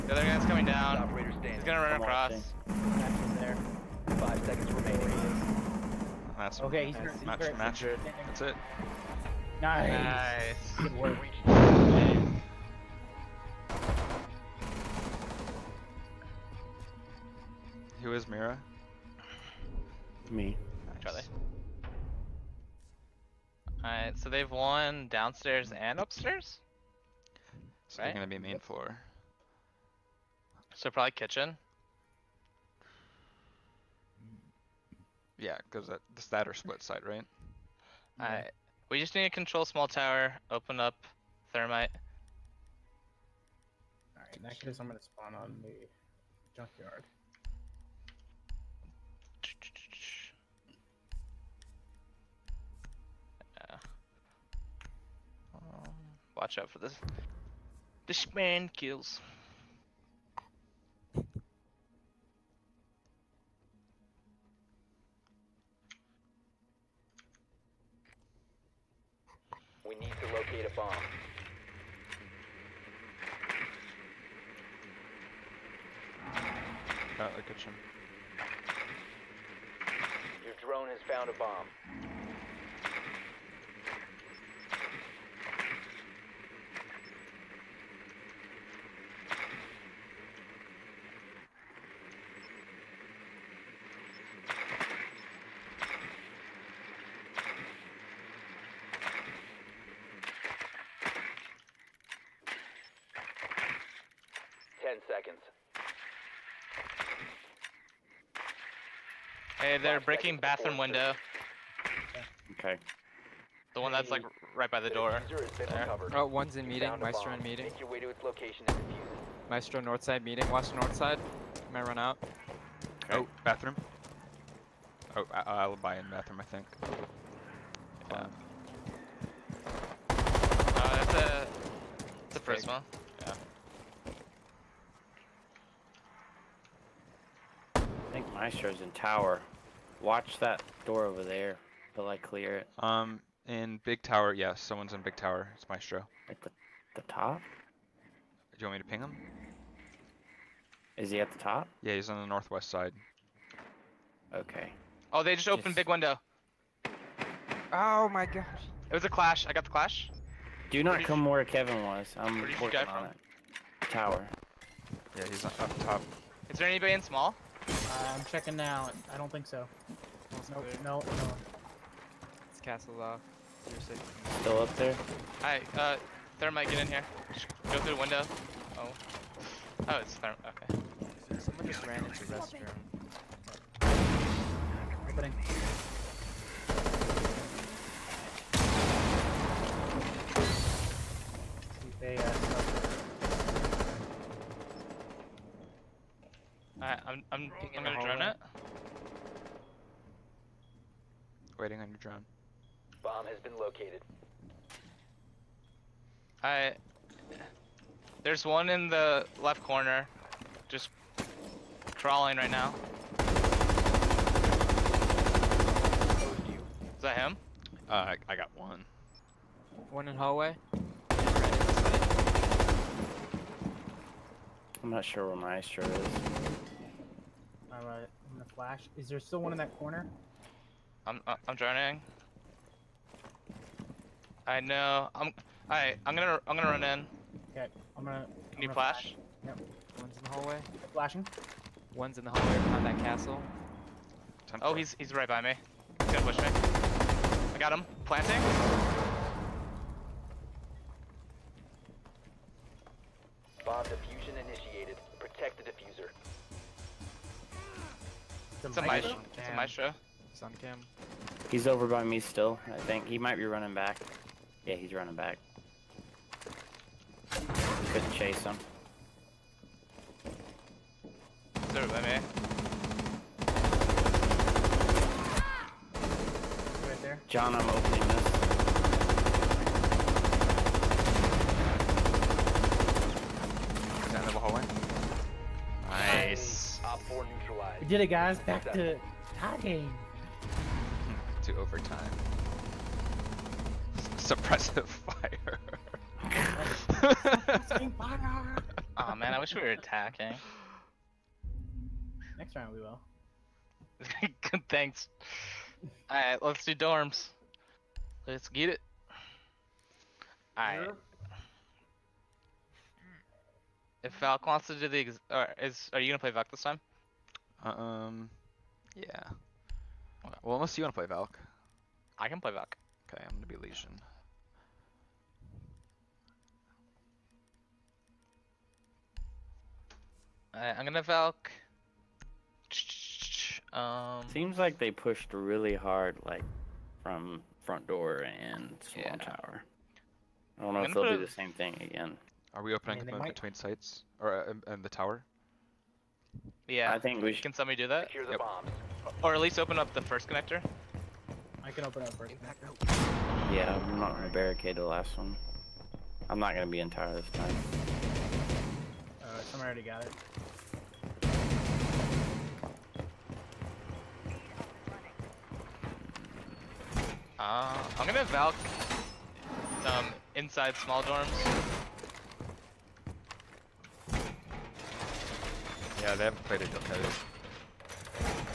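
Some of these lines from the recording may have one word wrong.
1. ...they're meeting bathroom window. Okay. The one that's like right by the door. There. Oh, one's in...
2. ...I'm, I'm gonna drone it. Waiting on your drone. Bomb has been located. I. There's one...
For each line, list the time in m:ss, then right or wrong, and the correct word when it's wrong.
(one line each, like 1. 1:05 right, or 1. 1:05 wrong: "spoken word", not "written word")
1. 1:49 wrong: "breaking", not "meeting"
2. 3:17 right.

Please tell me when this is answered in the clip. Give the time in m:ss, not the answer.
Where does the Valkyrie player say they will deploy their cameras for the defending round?
6:10.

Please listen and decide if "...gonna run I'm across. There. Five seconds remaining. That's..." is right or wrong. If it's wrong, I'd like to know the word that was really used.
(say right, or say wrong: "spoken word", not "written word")
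right.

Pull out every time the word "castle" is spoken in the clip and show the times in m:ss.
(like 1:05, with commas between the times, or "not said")
2:52, 4:02.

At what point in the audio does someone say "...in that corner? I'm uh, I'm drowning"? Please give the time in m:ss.
3:49.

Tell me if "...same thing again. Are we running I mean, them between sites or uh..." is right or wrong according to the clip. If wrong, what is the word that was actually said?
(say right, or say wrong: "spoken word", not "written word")
wrong: "opening", not "running".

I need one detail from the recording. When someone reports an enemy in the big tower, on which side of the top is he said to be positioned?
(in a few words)
northwest.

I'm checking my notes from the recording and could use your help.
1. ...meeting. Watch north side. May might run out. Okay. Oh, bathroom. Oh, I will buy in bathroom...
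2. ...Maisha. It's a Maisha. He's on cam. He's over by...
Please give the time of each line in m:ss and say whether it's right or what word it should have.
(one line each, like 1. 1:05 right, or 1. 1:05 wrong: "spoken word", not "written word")
1. 2:00 right
2. 4:18 right.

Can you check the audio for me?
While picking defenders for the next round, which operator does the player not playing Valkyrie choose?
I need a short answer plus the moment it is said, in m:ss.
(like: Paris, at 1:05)
Legion, at 5:23.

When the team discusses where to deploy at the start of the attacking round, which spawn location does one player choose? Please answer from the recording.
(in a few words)
junkyard.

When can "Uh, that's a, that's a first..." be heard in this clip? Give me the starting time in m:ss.
2:10.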